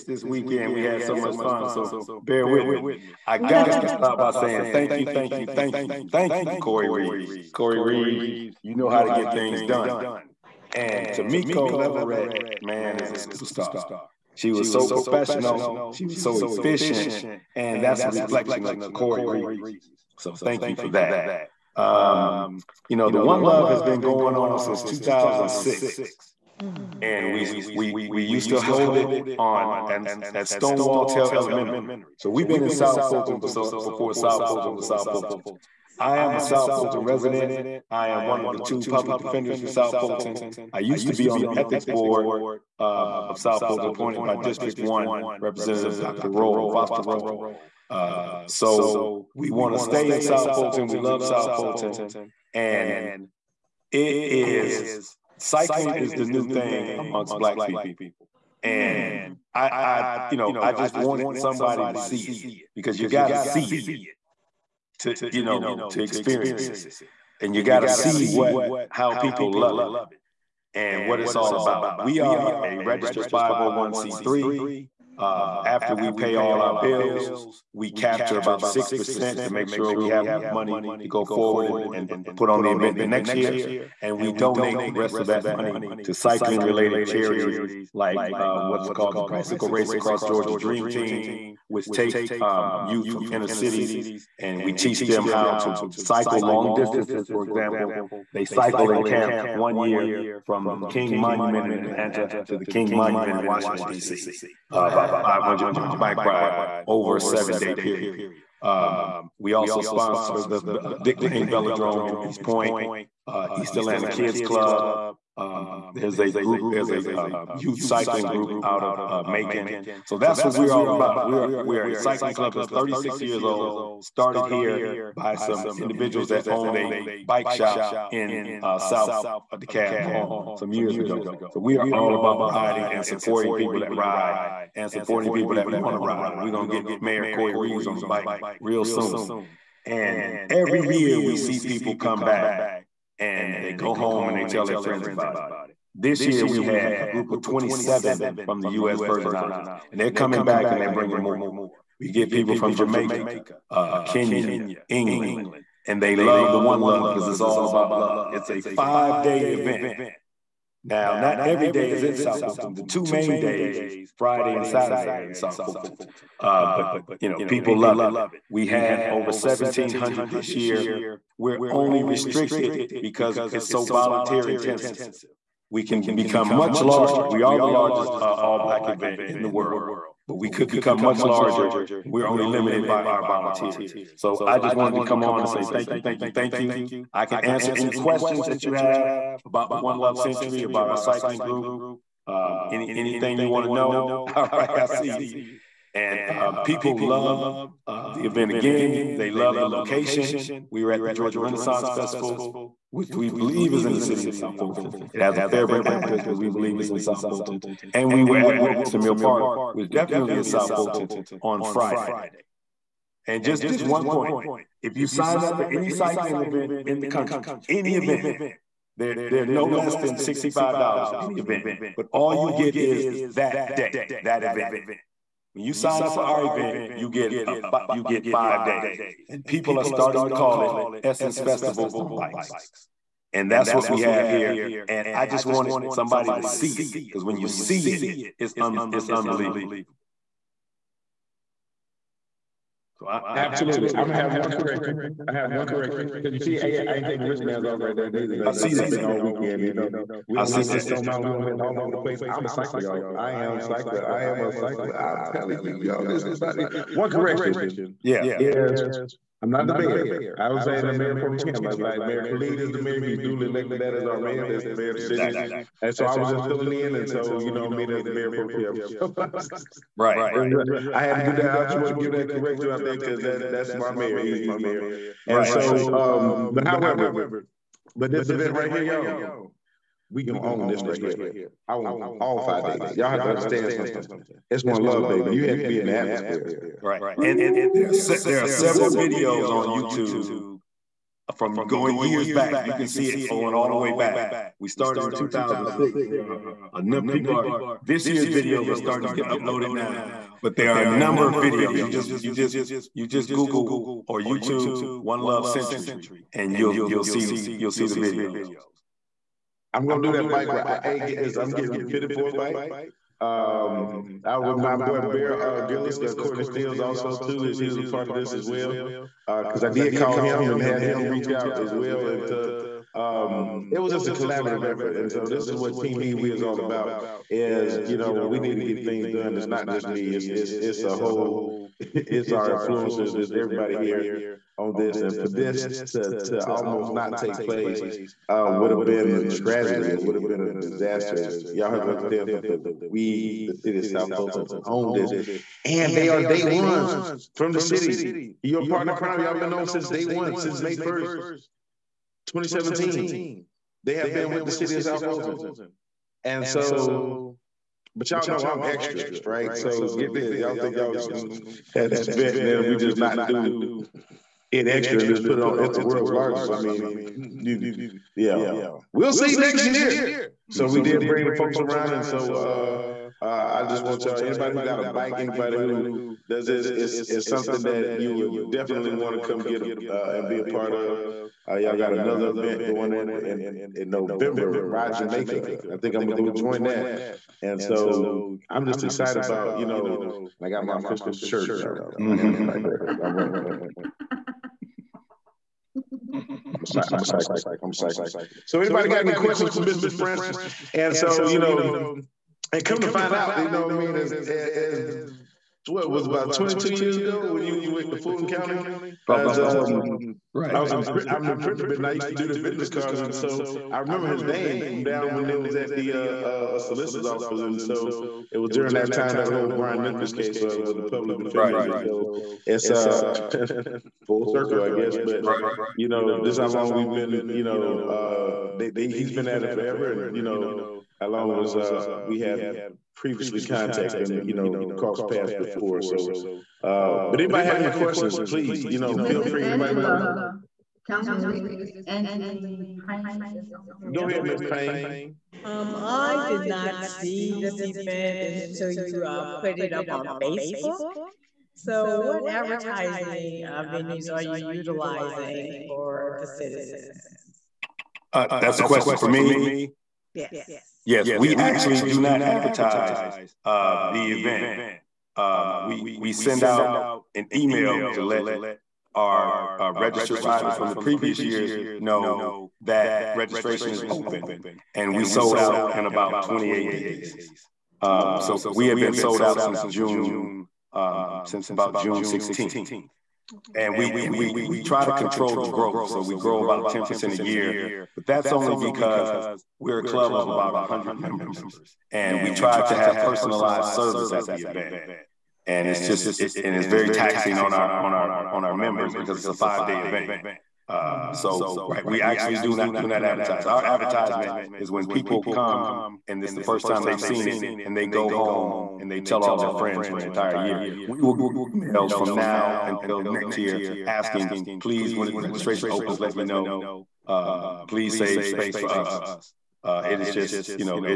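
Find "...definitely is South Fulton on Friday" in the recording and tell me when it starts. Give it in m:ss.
3:29.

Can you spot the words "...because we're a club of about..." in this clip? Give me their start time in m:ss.
8:08.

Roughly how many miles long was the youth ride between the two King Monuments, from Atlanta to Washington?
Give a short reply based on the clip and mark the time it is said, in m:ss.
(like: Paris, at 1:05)
500 miles, at 1:45.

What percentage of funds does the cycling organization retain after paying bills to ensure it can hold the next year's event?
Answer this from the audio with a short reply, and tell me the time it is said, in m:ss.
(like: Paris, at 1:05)
6%, at 1:18.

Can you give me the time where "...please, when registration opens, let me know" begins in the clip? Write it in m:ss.
8:34.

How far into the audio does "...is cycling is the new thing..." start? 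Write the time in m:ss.
0:54.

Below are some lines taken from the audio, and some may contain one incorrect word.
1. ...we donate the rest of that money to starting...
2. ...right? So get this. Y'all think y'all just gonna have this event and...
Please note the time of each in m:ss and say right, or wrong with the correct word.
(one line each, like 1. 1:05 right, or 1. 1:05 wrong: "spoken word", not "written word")
1. 1:24 wrong: "cycling", not "starting"
2. 5:59 right.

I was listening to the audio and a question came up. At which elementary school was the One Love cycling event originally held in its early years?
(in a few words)
Stonewall Tell Elementary.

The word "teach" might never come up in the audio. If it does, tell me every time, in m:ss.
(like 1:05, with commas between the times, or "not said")
1:34.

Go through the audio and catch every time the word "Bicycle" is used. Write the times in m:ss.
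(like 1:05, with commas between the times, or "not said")
1:29.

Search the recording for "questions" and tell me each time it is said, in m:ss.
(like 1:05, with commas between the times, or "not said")
3:07, 6:39, 7:17, 7:38.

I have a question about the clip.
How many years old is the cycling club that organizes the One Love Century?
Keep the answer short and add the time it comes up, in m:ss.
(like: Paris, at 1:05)
36, at 2:02.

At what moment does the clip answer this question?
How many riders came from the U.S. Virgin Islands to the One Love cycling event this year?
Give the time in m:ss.
2:27.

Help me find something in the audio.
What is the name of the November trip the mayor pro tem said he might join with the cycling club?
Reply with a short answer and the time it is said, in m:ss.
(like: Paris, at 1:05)
Ride Jamaica, at 6:24.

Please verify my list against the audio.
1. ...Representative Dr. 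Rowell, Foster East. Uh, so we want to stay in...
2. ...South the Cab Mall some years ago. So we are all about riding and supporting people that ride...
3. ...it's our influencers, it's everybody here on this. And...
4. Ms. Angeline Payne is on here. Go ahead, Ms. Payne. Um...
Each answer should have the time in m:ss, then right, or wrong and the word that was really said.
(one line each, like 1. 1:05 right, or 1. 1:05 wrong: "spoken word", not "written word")
1. 0:45 wrong: "Rowell", not "East"
2. 2:08 right
3. 5:31 right
4. 7:21 right.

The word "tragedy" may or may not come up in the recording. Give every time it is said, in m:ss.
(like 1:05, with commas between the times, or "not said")
5:39.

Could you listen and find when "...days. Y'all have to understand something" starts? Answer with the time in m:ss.
4:42.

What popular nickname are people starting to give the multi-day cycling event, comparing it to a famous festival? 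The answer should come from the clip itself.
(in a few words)
Essence Festival on bikes.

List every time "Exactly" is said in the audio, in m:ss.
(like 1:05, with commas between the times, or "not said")
4:25.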